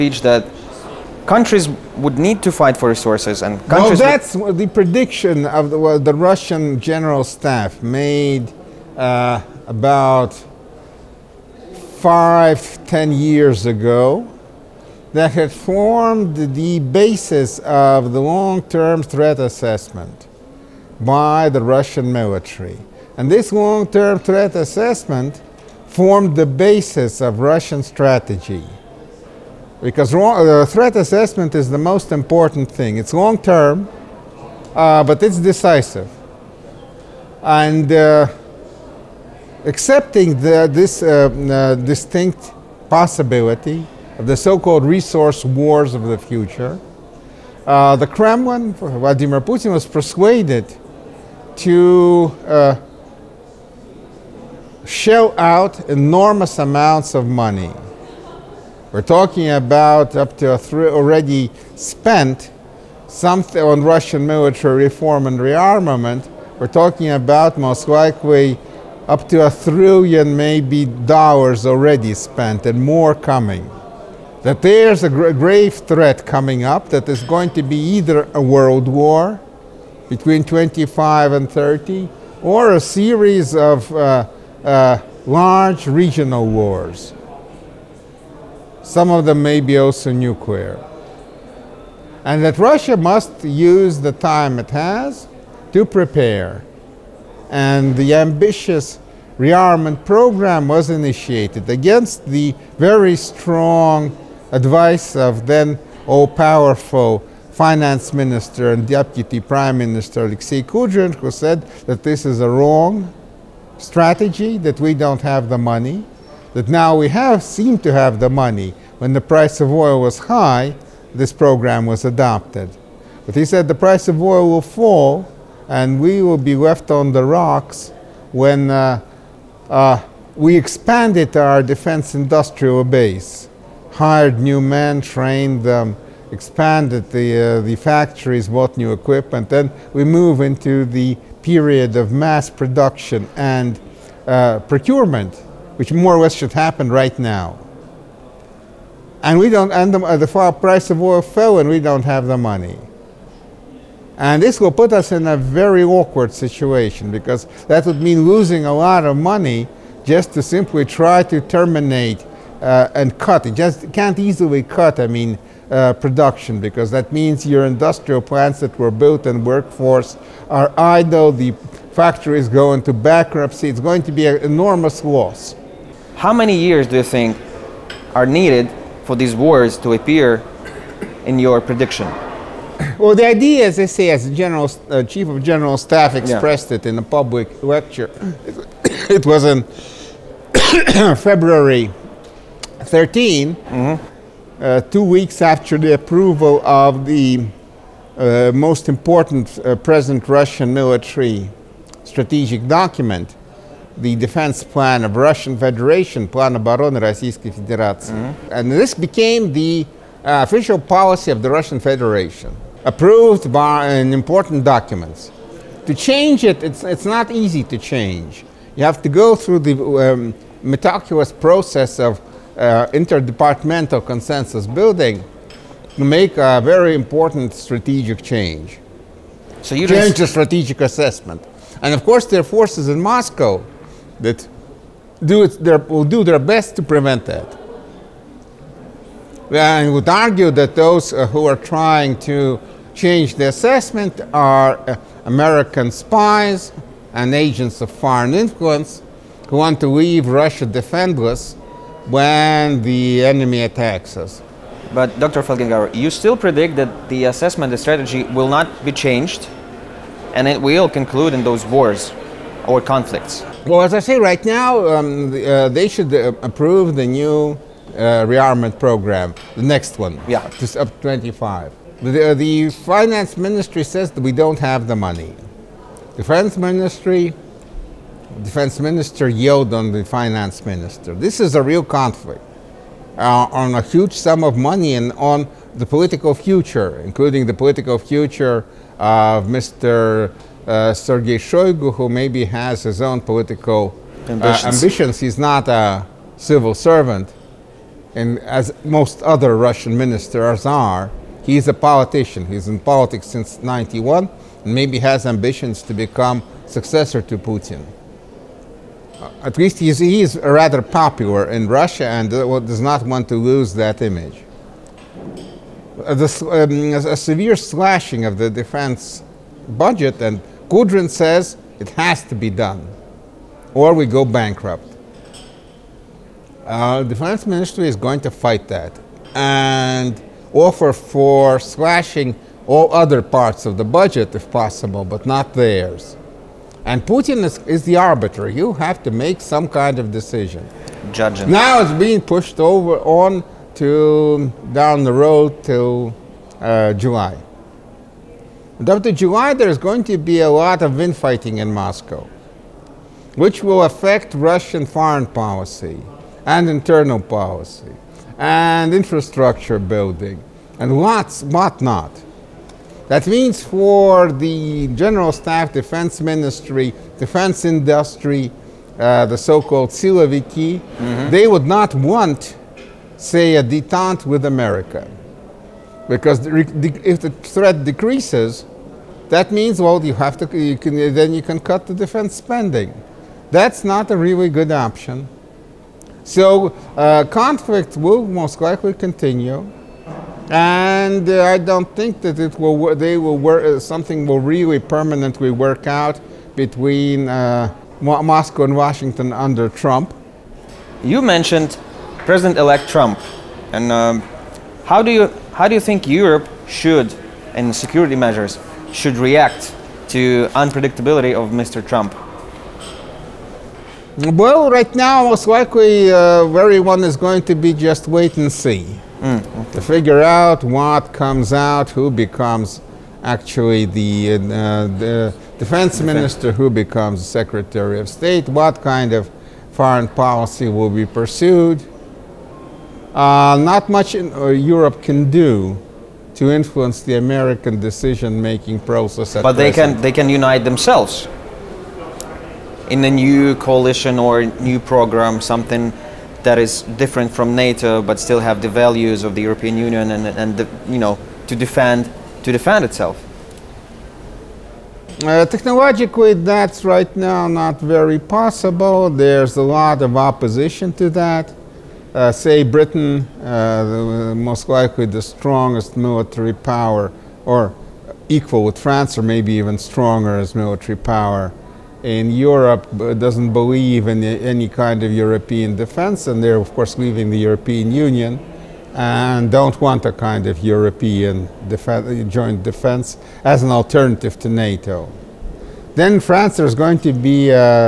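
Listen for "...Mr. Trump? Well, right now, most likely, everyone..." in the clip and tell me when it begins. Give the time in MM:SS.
06:51.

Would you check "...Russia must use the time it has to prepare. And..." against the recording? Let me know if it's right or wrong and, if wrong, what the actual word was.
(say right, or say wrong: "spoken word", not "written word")
right.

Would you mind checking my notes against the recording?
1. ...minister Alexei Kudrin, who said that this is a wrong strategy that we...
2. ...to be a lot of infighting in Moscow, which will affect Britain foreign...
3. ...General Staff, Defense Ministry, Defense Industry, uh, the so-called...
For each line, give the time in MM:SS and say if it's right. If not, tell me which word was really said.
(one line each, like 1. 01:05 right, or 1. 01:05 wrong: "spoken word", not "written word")
1. 01:49 right
2. 05:50 wrong: "Russian", not "Britain"
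3. 06:04 right.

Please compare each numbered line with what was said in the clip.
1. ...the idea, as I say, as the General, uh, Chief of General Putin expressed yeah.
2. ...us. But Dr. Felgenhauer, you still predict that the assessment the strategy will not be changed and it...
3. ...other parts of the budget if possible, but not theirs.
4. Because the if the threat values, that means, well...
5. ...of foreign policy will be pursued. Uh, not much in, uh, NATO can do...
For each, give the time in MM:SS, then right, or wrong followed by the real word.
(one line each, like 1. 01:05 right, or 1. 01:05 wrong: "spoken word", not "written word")
1. 03:03 wrong: "Staff", not "Putin"
2. 04:14 right
3. 05:32 right
4. 06:16 wrong: "decreases", not "values"
5. 07:09 wrong: "Europe", not "NATO".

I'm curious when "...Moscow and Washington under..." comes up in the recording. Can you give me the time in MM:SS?
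06:37.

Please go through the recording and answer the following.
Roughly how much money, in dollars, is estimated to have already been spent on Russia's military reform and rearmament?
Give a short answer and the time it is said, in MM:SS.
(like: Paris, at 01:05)
a trillion, at 01:09.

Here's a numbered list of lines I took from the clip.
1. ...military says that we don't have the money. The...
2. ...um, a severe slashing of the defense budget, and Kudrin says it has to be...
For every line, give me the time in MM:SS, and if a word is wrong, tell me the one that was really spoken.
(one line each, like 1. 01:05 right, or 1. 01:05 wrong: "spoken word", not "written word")
1. 04:33 wrong: "ministry", not "military"
2. 05:16 right.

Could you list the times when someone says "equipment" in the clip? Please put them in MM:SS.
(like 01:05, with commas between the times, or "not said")
02:18.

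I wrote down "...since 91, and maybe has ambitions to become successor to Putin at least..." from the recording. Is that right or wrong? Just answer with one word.
right.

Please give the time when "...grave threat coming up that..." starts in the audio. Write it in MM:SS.
01:15.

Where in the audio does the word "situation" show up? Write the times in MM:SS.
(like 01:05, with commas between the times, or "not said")
02:36.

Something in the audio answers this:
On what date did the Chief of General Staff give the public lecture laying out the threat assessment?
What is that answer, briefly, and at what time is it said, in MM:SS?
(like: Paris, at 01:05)
February 13, at 03:11.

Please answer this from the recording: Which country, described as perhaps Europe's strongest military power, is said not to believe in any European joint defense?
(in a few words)
Britain.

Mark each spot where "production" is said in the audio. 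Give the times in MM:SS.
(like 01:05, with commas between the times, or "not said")
02:22, 02:45.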